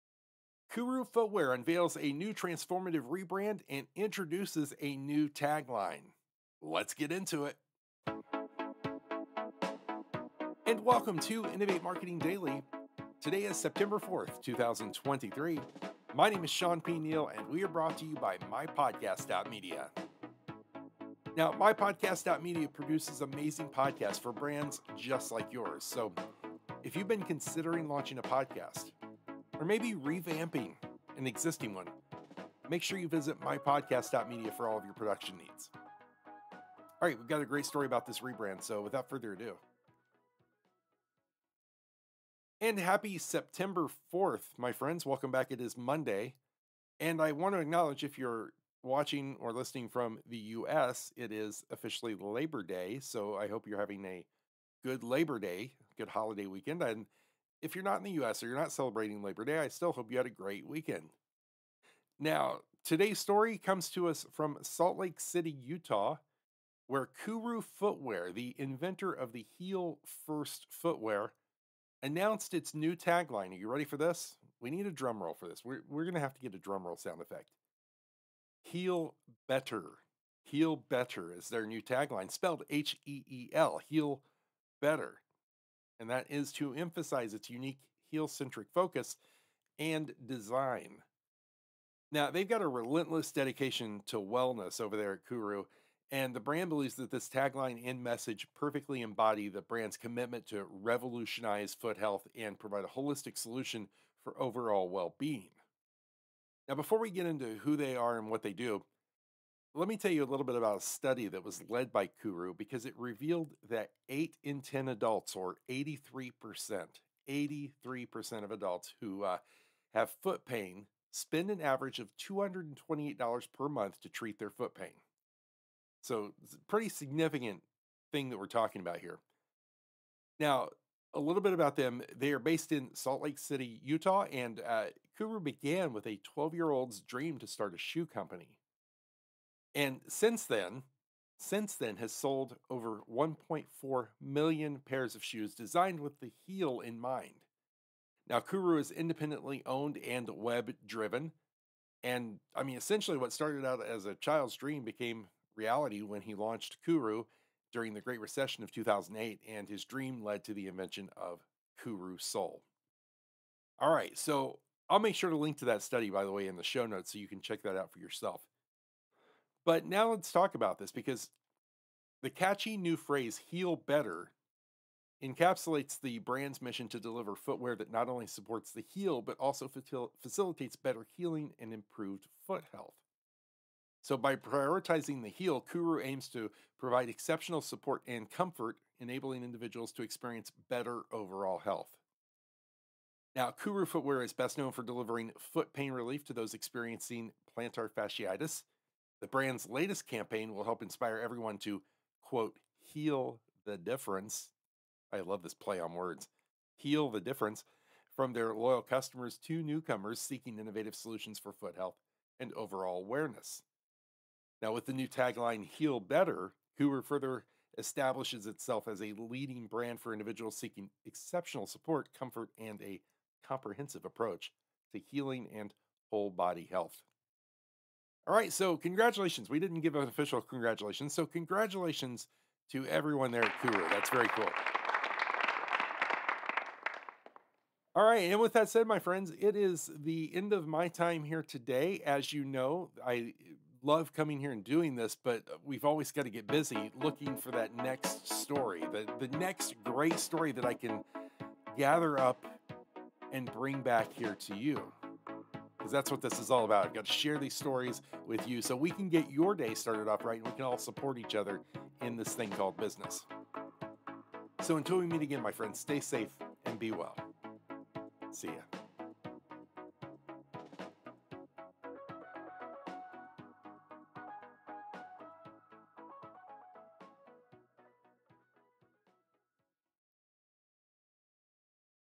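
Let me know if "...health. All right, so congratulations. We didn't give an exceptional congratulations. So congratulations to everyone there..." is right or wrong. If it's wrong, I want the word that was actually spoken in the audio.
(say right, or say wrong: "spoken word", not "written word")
wrong: "official", not "exceptional".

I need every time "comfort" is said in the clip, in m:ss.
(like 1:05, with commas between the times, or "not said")
3:08, 3:42.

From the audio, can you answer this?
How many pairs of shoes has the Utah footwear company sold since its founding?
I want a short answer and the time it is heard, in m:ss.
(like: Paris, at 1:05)
1.4 million, at 2:23.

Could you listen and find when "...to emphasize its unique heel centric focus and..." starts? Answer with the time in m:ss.
1:26.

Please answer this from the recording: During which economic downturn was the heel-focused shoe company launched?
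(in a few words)
Great Recession of 2008.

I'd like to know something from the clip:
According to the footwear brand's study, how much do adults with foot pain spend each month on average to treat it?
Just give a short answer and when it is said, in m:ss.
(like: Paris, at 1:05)
$228, at 2:02.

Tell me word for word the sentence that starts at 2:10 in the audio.
Now, a little bit about them.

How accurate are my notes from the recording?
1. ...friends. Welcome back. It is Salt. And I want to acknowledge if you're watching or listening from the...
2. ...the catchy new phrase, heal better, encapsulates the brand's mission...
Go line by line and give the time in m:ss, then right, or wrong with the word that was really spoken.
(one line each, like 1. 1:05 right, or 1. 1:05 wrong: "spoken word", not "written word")
1. 0:44 wrong: "Monday", not "Salt"
2. 2:52 right.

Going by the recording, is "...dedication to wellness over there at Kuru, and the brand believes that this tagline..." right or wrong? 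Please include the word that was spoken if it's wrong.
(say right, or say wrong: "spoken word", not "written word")
right.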